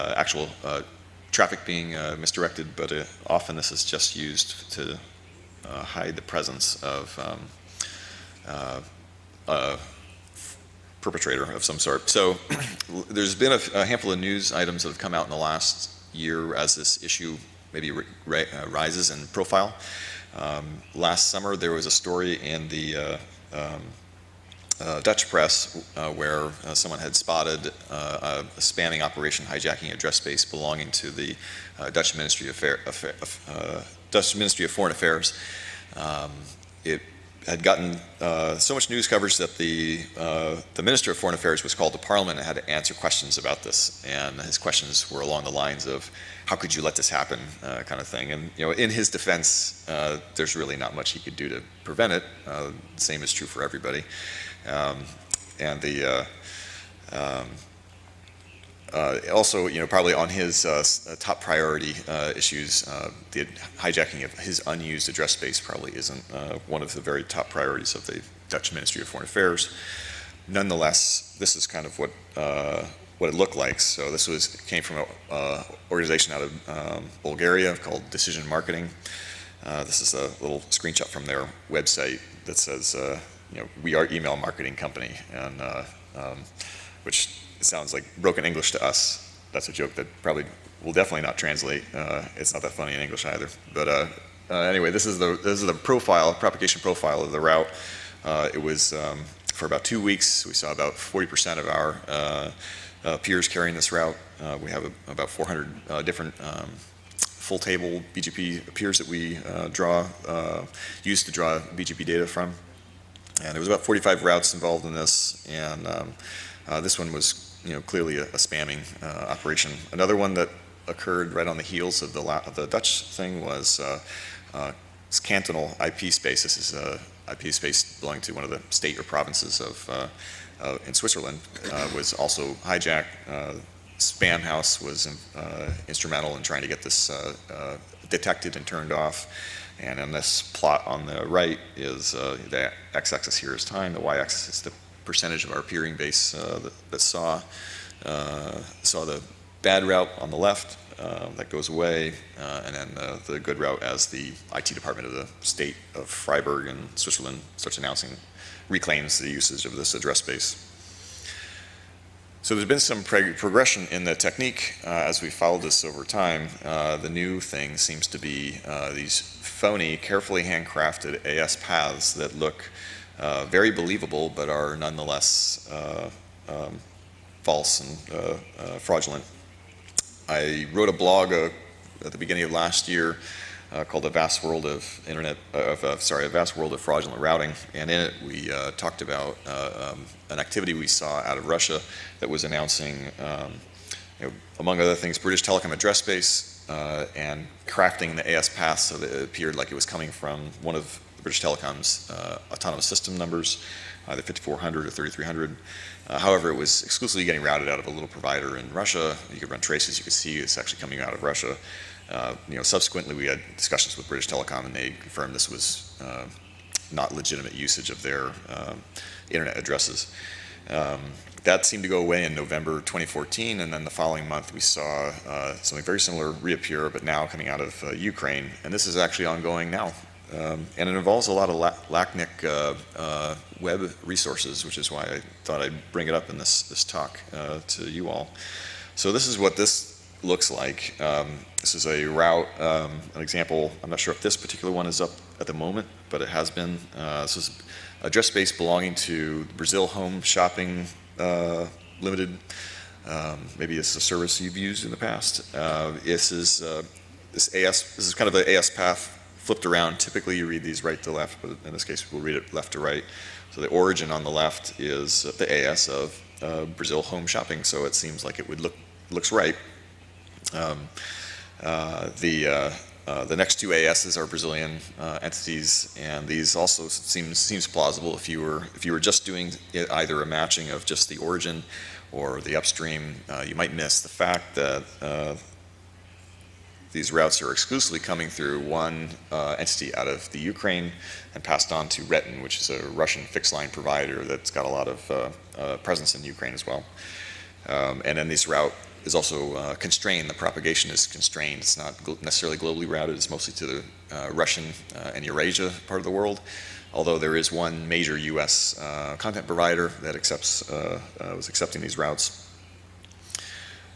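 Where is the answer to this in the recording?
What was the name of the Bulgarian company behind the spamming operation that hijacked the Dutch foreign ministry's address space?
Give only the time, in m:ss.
1:18.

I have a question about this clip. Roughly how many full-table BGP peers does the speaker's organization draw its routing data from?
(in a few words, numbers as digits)
400.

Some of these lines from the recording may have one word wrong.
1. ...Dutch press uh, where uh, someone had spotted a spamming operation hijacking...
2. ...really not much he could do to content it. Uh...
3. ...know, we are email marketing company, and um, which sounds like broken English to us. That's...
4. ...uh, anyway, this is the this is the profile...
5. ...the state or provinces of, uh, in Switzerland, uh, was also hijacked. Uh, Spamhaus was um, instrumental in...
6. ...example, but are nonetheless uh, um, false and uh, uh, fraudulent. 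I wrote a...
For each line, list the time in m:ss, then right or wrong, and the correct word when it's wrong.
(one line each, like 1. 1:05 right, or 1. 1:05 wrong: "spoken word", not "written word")
1. 0:25 right
2. 0:50 wrong: "prevent", not "content"
3. 1:23 right
4. 1:34 right
5. 2:08 right
6. 2:53 wrong: "believable", not "example".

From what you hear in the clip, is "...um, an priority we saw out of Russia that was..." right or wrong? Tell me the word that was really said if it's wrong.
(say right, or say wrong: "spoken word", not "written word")
wrong: "activity", not "priority".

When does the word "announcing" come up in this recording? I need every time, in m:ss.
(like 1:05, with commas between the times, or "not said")
2:37, 3:12.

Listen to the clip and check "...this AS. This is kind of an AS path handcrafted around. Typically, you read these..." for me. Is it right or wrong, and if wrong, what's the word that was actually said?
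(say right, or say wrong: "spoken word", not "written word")
wrong: "flipped", not "handcrafted".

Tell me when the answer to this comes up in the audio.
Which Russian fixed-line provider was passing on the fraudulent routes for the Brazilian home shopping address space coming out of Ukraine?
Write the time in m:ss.
4:52.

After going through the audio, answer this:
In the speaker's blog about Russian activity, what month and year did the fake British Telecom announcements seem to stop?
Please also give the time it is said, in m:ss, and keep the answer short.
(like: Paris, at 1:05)
November 2014, at 3:42.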